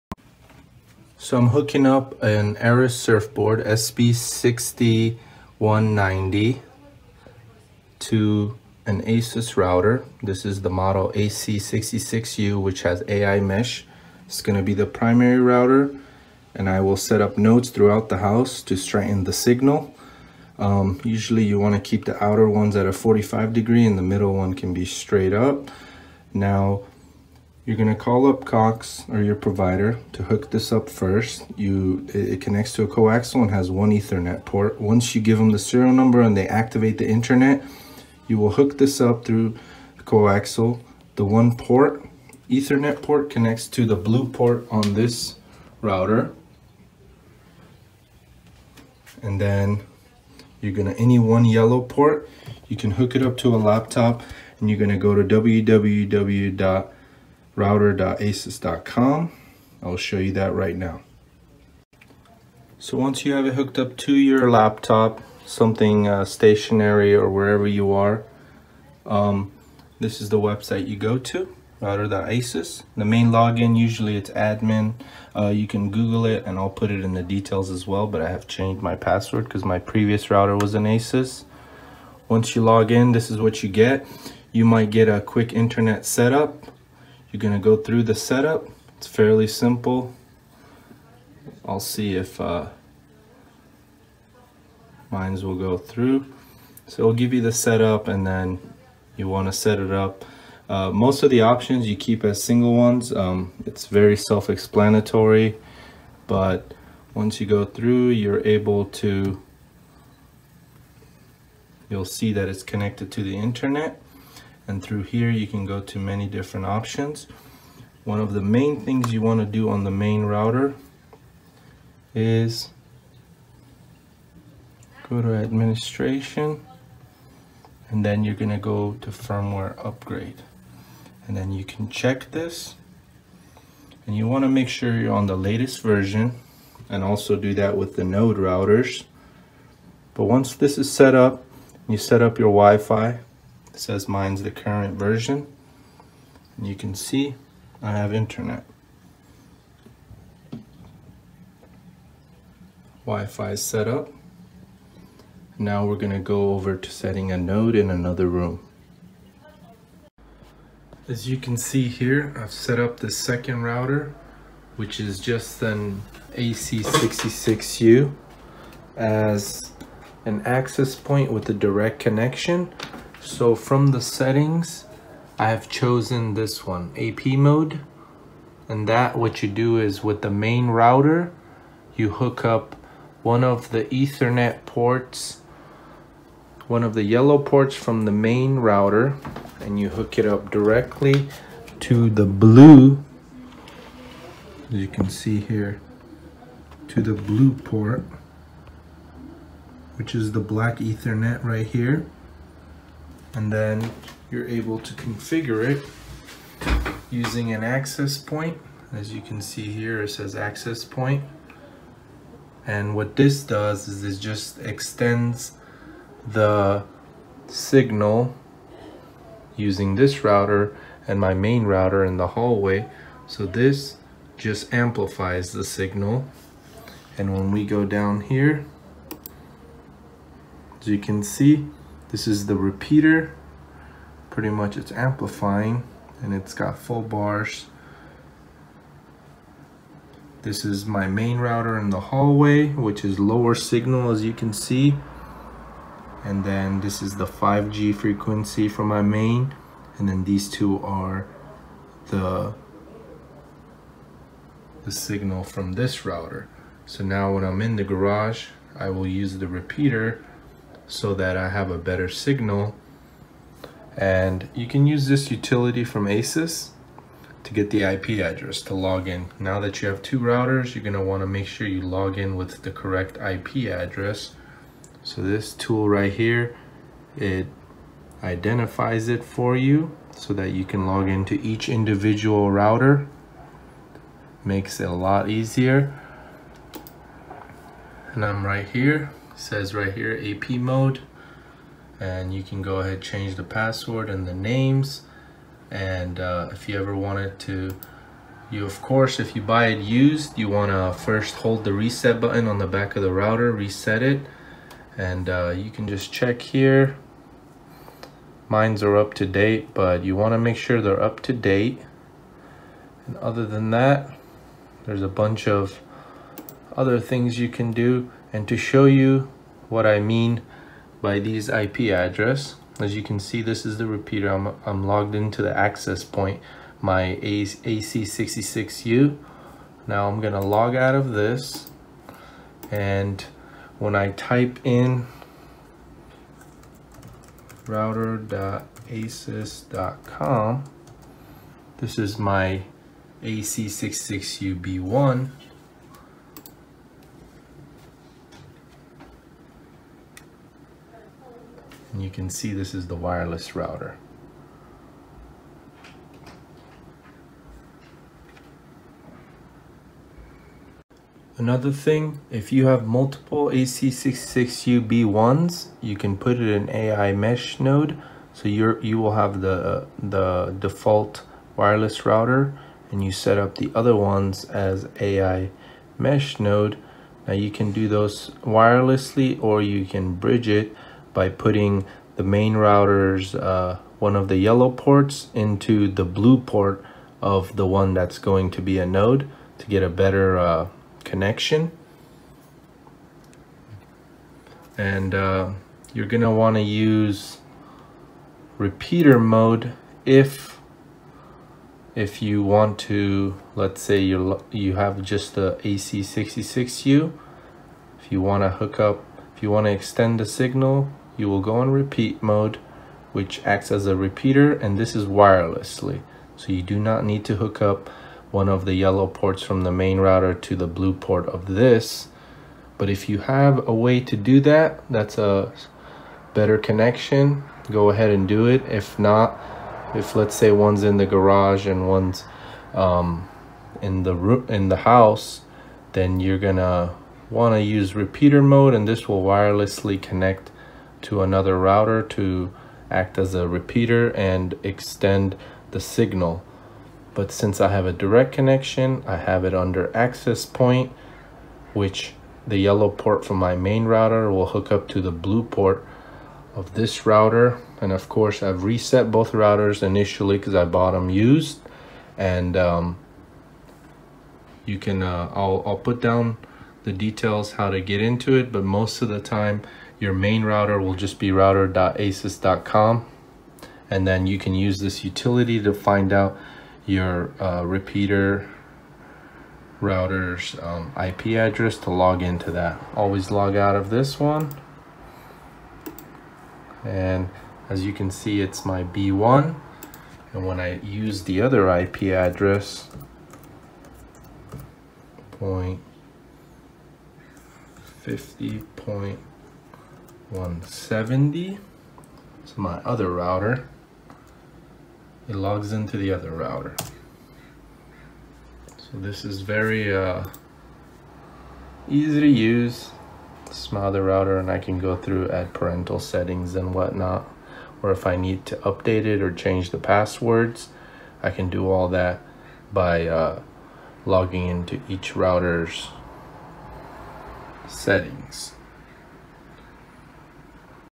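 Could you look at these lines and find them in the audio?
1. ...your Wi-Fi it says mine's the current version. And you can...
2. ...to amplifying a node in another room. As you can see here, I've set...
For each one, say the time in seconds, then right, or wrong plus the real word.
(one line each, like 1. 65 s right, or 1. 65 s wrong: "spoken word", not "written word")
1. 142 s right
2. 156 s wrong: "setting", not "amplifying".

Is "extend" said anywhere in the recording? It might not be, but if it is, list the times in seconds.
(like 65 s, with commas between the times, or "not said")
214 s, 409 s, 444 s.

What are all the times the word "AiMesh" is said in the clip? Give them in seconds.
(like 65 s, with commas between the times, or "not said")
13 s, 366 s.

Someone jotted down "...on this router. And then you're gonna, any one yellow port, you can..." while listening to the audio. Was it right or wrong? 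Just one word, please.
right.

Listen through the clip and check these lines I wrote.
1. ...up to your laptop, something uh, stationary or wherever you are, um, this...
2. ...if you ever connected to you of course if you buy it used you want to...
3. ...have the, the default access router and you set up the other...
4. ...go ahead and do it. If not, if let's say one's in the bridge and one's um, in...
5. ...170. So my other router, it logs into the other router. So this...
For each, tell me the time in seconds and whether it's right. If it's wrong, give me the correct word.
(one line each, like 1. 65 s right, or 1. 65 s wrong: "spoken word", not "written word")
1. 63 s right
2. 296 s wrong: "wanted", not "connected"
3. 369 s wrong: "wireless", not "access"
4. 427 s wrong: "garage", not "bridge"
5. 500 s right.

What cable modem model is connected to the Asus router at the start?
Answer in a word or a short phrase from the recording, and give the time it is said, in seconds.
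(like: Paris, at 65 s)
SB6190, at 3 s.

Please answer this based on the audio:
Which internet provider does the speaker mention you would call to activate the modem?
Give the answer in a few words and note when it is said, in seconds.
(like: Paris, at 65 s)
Cox, at 28 s.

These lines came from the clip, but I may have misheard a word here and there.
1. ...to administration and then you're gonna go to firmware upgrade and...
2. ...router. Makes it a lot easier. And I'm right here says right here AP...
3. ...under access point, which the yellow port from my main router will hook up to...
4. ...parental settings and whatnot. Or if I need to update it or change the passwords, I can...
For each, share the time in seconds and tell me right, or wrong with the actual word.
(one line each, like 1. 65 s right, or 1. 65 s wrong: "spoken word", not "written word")
1. 125 s right
2. 282 s right
3. 449 s right
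4. 515 s right.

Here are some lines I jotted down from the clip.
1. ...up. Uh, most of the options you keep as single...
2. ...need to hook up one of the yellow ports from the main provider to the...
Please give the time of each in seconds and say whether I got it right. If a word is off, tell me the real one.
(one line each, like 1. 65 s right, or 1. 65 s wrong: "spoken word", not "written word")
1. 99 s right
2. 417 s wrong: "router", not "provider".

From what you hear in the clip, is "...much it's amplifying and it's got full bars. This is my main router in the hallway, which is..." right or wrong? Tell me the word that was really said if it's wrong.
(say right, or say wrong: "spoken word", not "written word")
right.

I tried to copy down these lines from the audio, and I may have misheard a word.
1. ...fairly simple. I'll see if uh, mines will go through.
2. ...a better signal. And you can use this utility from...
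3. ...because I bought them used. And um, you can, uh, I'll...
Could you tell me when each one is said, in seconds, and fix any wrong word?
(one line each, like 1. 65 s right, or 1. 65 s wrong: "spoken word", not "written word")
1. 89 s right
2. 261 s right
3. 460 s right.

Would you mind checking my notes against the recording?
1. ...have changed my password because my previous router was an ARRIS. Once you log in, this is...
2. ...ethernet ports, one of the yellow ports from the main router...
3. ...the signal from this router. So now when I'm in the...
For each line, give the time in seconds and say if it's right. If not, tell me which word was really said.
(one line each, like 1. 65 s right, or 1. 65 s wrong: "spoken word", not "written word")
1. 78 s wrong: "Asus", not "ARRIS"
2. 183 s right
3. 254 s right.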